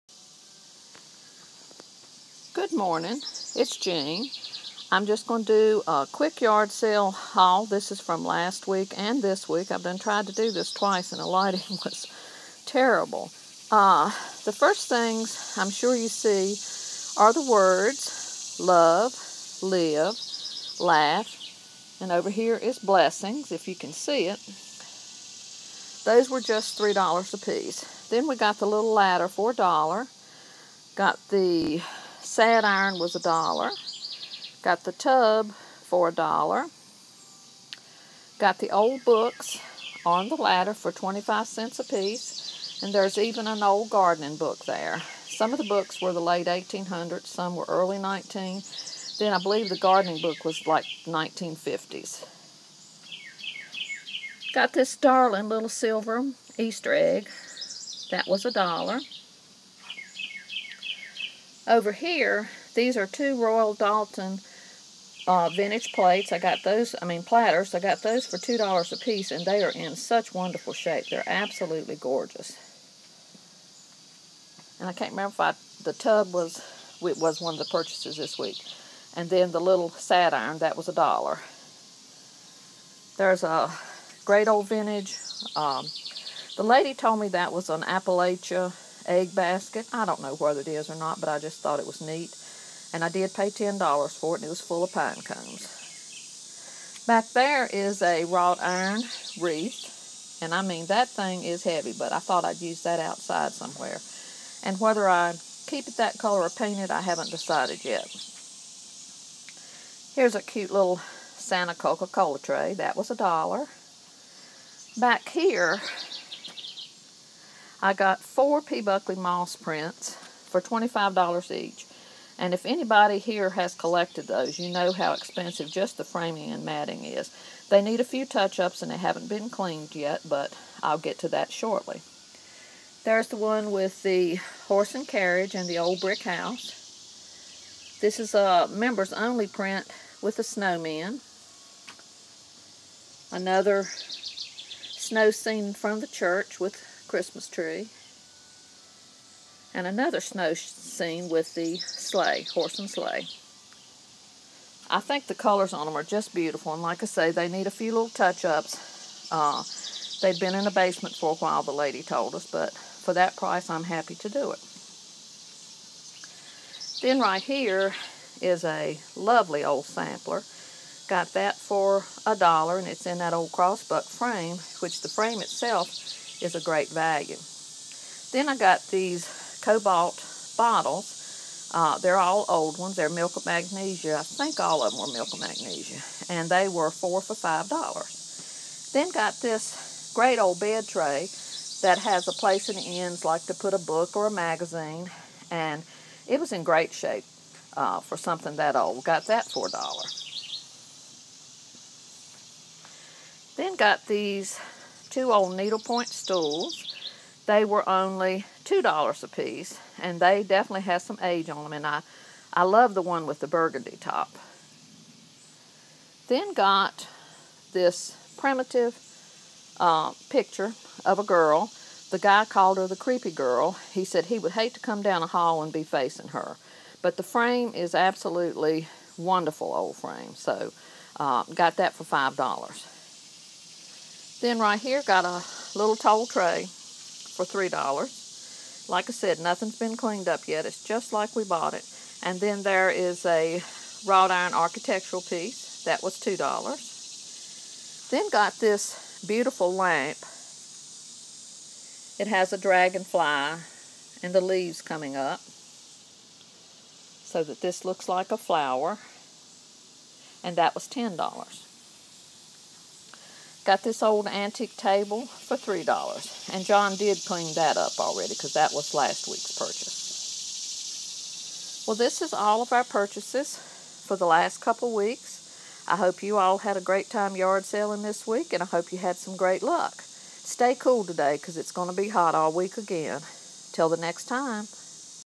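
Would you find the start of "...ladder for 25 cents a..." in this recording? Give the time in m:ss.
0:40.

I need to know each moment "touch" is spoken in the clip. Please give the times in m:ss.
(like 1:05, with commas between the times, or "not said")
2:08, 2:38.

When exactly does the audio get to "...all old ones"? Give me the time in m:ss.
3:02.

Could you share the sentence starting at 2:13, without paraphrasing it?
There's the one with the horse and carriage and the old brick house.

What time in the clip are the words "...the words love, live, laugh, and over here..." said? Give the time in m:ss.
0:17.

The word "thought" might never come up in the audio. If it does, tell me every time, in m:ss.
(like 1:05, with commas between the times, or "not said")
1:31, 1:42.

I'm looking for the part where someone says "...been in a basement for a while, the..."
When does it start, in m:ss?
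2:40.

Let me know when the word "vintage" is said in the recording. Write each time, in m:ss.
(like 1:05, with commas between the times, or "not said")
1:05, 1:24.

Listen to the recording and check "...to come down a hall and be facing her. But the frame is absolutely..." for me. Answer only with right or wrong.
right.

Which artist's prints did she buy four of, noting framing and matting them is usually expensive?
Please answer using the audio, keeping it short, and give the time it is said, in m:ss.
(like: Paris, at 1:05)
P. Buckley Moss, at 1:58.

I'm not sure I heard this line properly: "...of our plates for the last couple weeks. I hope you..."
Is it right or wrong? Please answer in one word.
wrong.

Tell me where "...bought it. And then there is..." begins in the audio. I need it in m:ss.
4:01.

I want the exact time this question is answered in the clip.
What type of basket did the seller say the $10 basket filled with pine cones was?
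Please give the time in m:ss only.
1:27.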